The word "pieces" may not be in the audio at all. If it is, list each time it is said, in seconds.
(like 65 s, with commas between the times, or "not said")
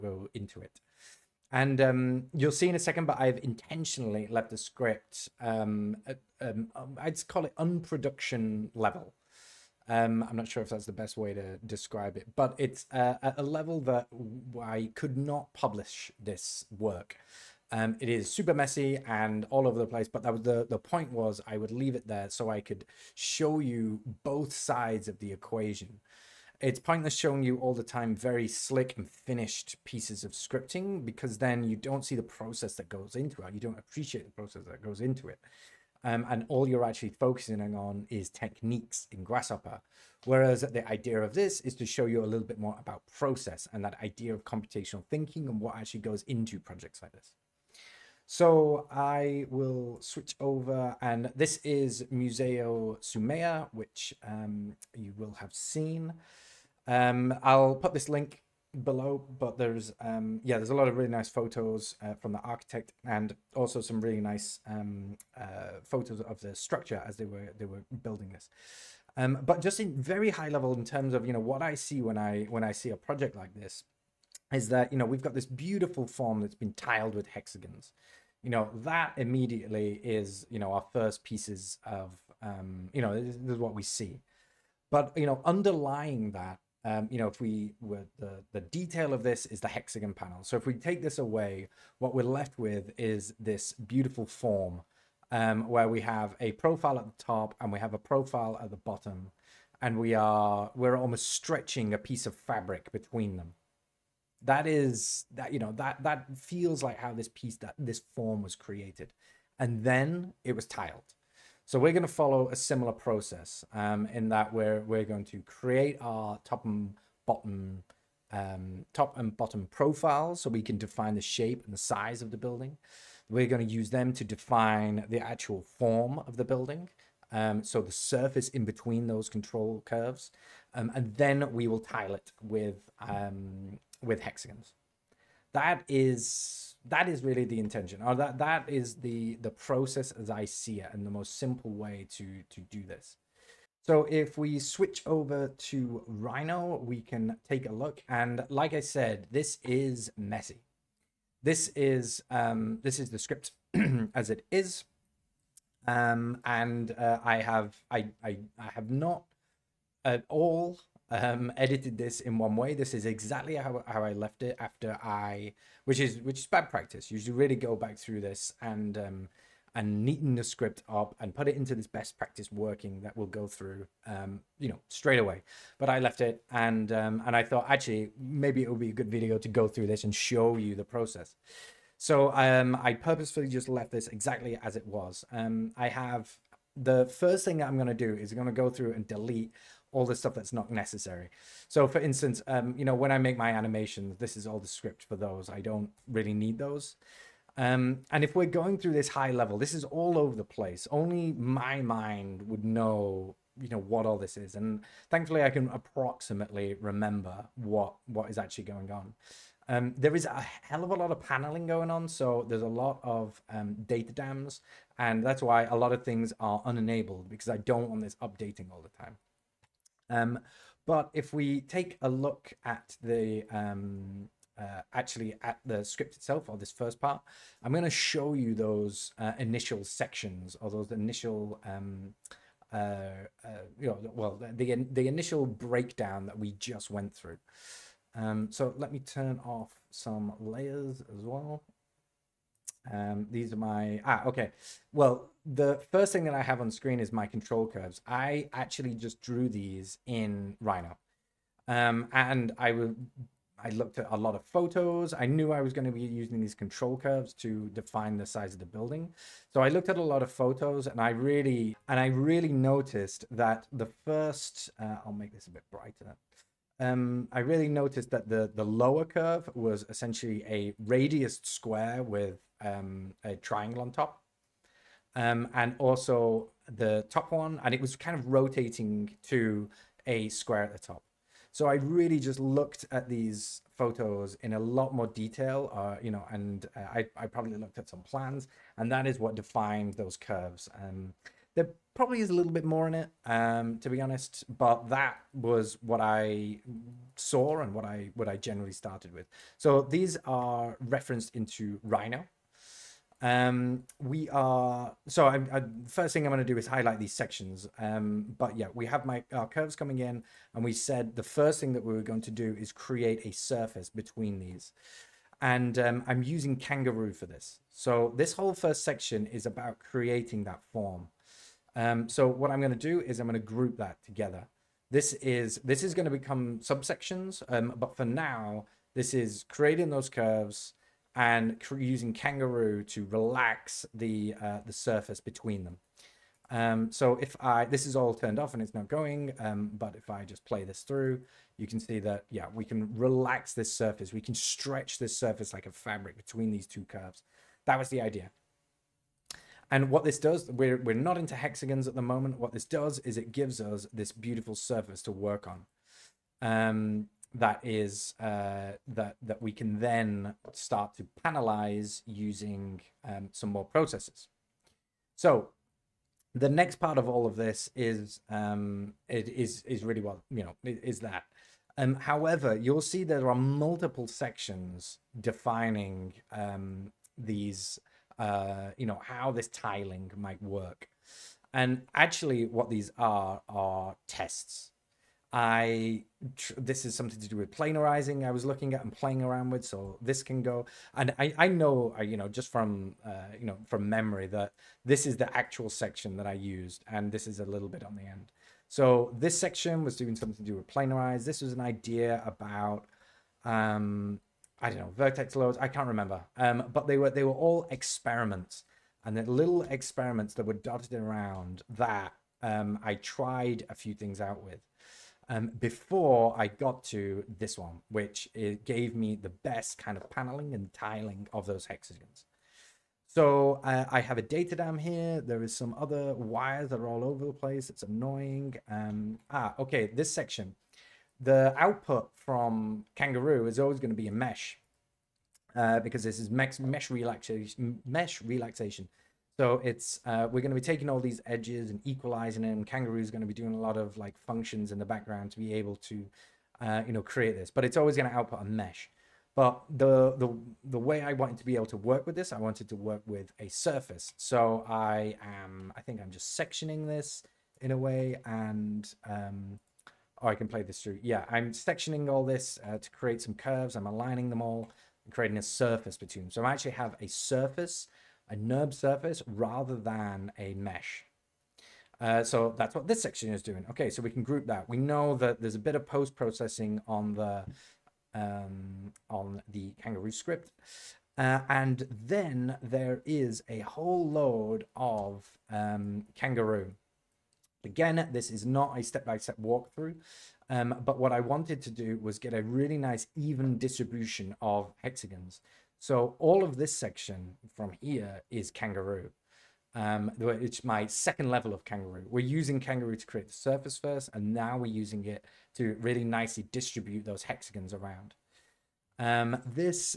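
29 s, 81 s, 101 s, 107 s.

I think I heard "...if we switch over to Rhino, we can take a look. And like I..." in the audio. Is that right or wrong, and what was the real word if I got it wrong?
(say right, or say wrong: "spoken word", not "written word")
right.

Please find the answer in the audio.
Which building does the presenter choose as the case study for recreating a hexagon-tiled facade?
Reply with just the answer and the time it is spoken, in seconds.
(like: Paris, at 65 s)
Museo Soumaya, at 52 s.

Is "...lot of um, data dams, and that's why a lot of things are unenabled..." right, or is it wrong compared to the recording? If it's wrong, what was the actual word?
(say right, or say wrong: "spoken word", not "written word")
right.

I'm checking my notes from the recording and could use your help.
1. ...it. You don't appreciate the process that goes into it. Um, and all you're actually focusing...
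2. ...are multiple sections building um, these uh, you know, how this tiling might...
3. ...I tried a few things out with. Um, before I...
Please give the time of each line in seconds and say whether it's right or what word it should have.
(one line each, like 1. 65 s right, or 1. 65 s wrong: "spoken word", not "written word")
1. 33 s right
2. 373 s wrong: "defining", not "building"
3. 412 s right.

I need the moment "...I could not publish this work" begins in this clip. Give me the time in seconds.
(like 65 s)
14 s.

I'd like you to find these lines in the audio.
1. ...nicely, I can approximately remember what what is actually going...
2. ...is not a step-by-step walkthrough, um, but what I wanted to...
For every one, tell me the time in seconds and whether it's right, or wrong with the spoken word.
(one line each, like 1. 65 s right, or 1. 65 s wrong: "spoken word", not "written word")
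1. 205 s wrong: "thankfully", not "nicely"
2. 488 s right.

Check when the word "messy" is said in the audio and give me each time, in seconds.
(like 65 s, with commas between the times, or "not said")
18 s, 150 s.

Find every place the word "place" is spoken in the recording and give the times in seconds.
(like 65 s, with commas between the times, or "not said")
19 s, 200 s, 427 s.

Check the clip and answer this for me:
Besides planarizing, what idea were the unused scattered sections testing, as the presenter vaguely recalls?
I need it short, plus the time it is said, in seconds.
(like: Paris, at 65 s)
Vertex loads, at 404 s.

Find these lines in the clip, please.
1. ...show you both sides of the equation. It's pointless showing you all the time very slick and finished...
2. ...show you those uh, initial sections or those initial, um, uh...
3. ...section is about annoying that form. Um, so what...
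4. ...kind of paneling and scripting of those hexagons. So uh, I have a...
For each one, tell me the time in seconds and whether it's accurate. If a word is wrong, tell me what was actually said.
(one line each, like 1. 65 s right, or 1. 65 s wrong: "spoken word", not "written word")
1. 23 s right
2. 227 s right
3. 318 s wrong: "creating", not "annoying"
4. 419 s wrong: "tiling", not "scripting".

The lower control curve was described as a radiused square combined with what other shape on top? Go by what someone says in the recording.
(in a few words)
A triangle.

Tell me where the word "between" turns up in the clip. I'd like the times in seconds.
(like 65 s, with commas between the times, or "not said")
102 s, 128 s, 313 s, 335 s, 346 s, 465 s.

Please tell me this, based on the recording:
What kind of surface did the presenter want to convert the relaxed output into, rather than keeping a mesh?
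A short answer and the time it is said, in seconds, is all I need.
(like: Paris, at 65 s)
NURB surface, at 468 s.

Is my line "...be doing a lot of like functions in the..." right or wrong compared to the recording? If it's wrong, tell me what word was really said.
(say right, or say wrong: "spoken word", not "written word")
right.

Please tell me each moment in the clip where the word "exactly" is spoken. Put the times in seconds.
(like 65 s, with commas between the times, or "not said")
163 s, 184 s.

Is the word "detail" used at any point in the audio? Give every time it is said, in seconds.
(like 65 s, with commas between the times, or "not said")
88 s, 285 s.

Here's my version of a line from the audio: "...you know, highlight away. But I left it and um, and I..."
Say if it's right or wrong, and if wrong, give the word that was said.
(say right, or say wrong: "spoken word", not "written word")
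wrong: "straight", not "highlight".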